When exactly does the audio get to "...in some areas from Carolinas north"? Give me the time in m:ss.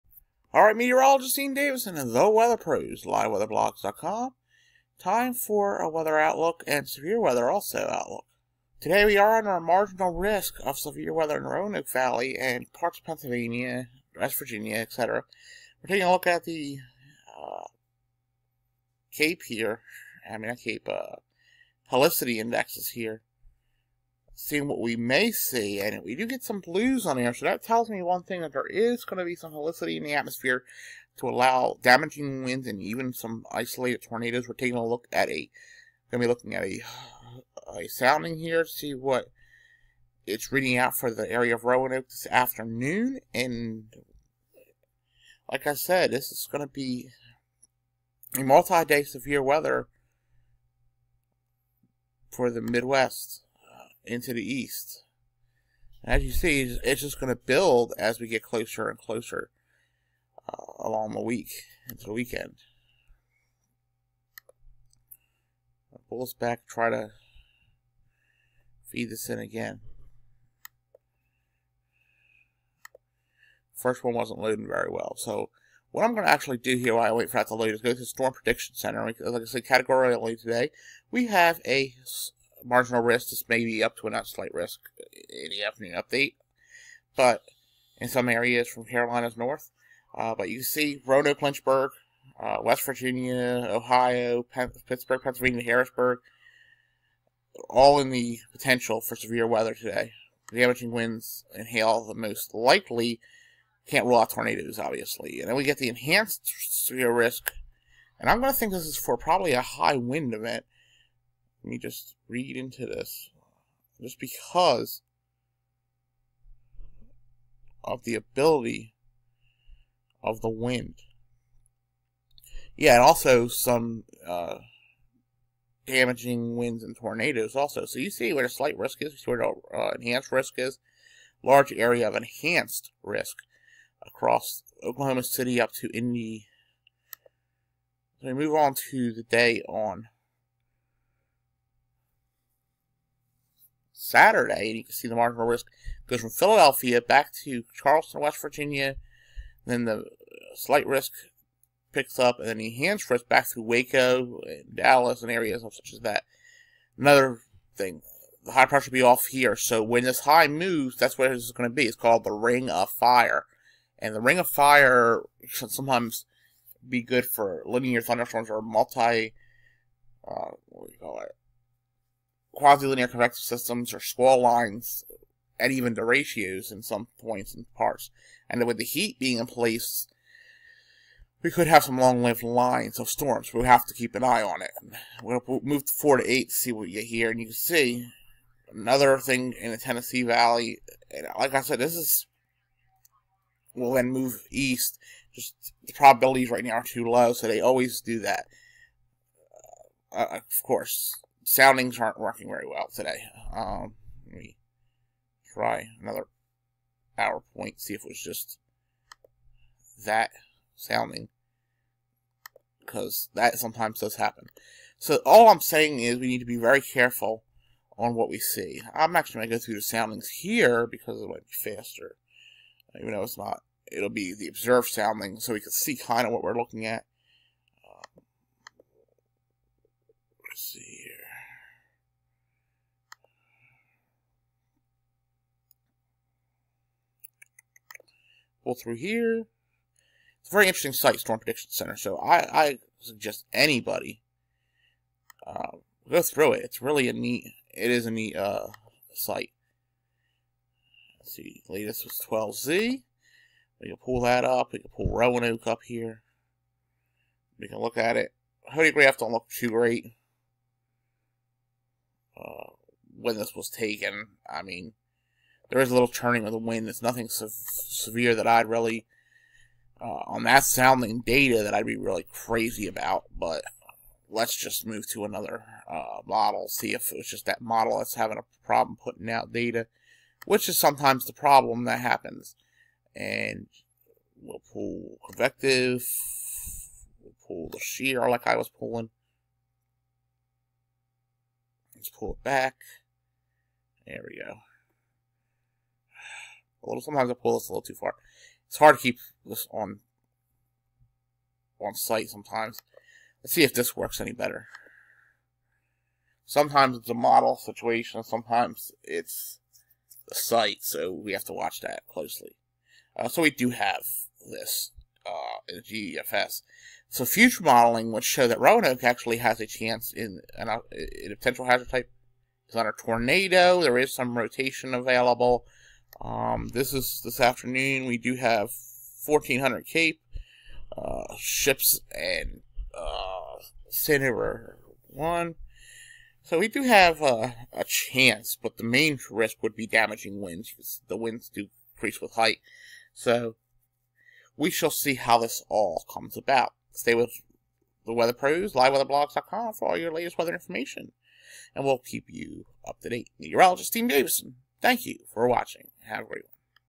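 1:27.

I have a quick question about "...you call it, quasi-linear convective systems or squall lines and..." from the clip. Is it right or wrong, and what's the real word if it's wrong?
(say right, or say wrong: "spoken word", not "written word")
right.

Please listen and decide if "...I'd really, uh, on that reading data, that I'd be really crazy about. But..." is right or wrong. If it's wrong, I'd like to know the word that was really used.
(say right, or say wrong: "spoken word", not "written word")
wrong: "sounding", not "reading".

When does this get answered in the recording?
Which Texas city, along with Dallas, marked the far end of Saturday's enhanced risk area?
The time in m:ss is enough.
2:33.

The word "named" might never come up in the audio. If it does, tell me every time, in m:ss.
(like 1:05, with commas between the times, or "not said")
not said.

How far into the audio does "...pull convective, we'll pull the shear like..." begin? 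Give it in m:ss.
4:44.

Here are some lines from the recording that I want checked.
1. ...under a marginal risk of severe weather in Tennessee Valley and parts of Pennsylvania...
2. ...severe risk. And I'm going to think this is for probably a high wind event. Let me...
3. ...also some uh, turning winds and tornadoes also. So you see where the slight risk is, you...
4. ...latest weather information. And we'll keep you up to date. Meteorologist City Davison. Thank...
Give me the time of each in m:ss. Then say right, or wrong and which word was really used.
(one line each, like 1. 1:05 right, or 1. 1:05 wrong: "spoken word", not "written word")
1. 0:09 wrong: "Roanoke", not "Tennessee"
2. 1:46 right
3. 2:03 wrong: "damaging", not "turning"
4. 5:50 wrong: "Steve", not "City".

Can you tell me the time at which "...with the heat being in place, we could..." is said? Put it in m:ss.
2:58.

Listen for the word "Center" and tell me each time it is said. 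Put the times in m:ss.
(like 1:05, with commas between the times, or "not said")
1:18, 4:01.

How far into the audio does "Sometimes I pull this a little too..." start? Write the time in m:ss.
4:57.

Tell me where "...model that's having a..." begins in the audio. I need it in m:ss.
4:37.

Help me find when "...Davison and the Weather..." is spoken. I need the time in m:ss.
0:01.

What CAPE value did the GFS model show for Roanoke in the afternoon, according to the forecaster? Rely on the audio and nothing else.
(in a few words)
1400.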